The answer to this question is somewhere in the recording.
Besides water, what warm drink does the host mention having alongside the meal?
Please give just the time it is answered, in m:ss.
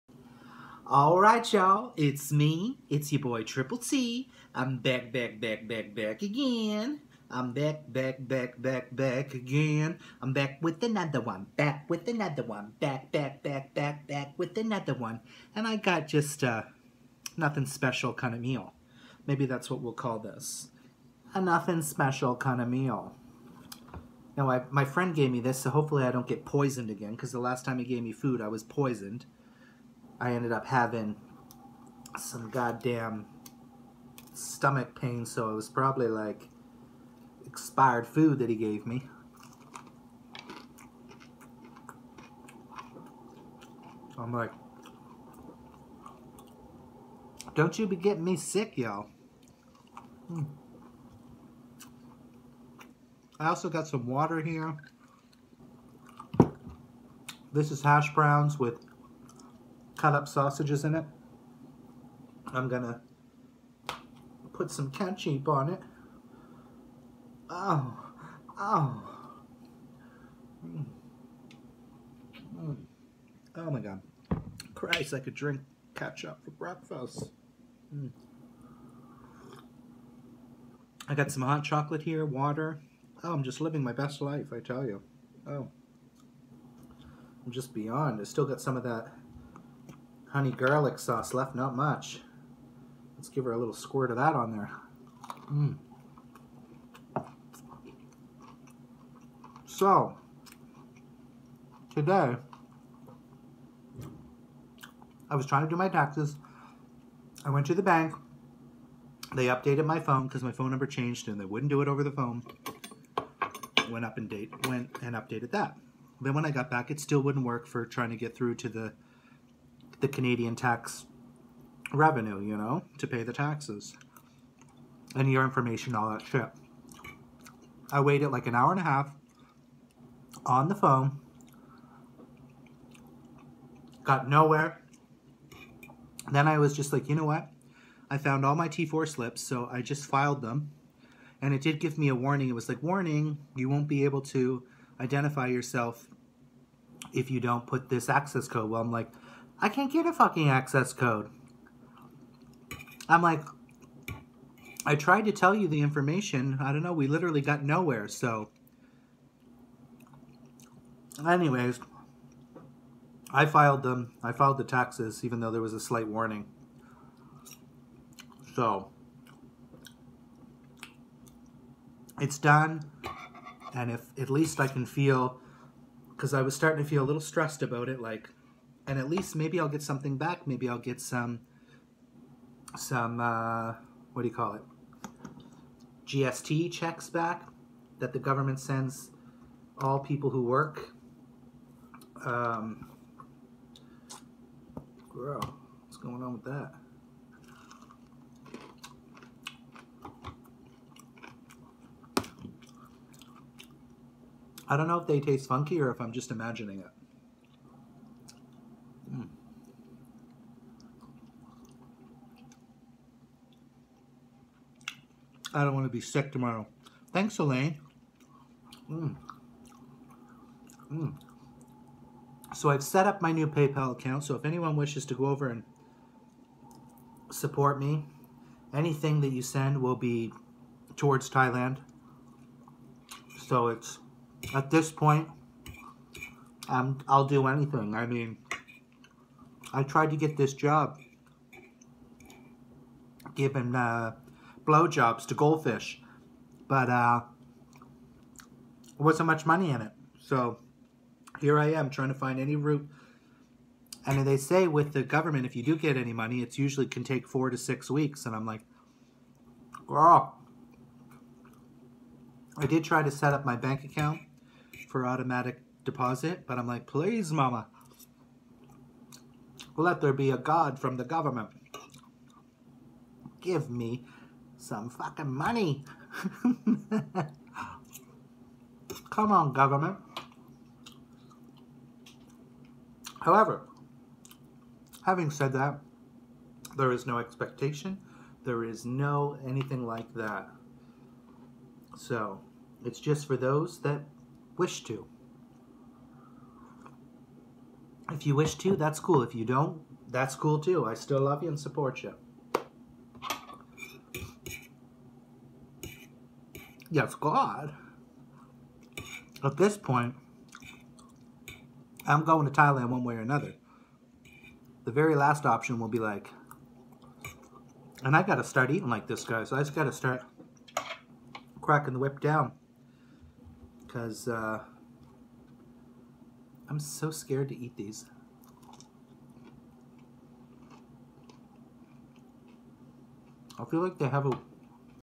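1:21.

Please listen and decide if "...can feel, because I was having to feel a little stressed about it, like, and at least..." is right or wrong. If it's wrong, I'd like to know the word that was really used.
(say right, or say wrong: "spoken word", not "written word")
wrong: "starting", not "having".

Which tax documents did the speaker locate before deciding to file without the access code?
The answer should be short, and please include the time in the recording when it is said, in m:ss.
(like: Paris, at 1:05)
T4 slips, at 2:18.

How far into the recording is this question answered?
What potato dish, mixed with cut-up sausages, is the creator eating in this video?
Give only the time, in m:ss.
0:57.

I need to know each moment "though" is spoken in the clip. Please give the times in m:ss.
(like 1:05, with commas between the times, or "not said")
2:45.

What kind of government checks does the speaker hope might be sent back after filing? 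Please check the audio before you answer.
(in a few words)
GST checks.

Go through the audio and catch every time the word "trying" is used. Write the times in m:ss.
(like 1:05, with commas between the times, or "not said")
1:45, 1:57, 4:11.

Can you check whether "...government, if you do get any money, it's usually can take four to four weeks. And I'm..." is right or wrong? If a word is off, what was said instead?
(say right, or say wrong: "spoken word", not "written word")
wrong: "six", not "four".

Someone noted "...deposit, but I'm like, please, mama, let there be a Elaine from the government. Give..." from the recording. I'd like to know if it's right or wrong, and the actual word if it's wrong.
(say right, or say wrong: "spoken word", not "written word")
wrong: "God", not "Elaine".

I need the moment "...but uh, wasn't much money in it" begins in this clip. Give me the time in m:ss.
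4:06.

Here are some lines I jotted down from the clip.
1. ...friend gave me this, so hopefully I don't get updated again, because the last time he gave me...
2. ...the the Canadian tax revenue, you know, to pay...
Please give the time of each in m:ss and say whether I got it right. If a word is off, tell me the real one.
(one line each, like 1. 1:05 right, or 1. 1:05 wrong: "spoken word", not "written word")
1. 0:24 wrong: "poisoned", not "updated"
2. 1:58 right.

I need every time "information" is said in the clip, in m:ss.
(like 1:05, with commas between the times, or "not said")
2:05, 2:35.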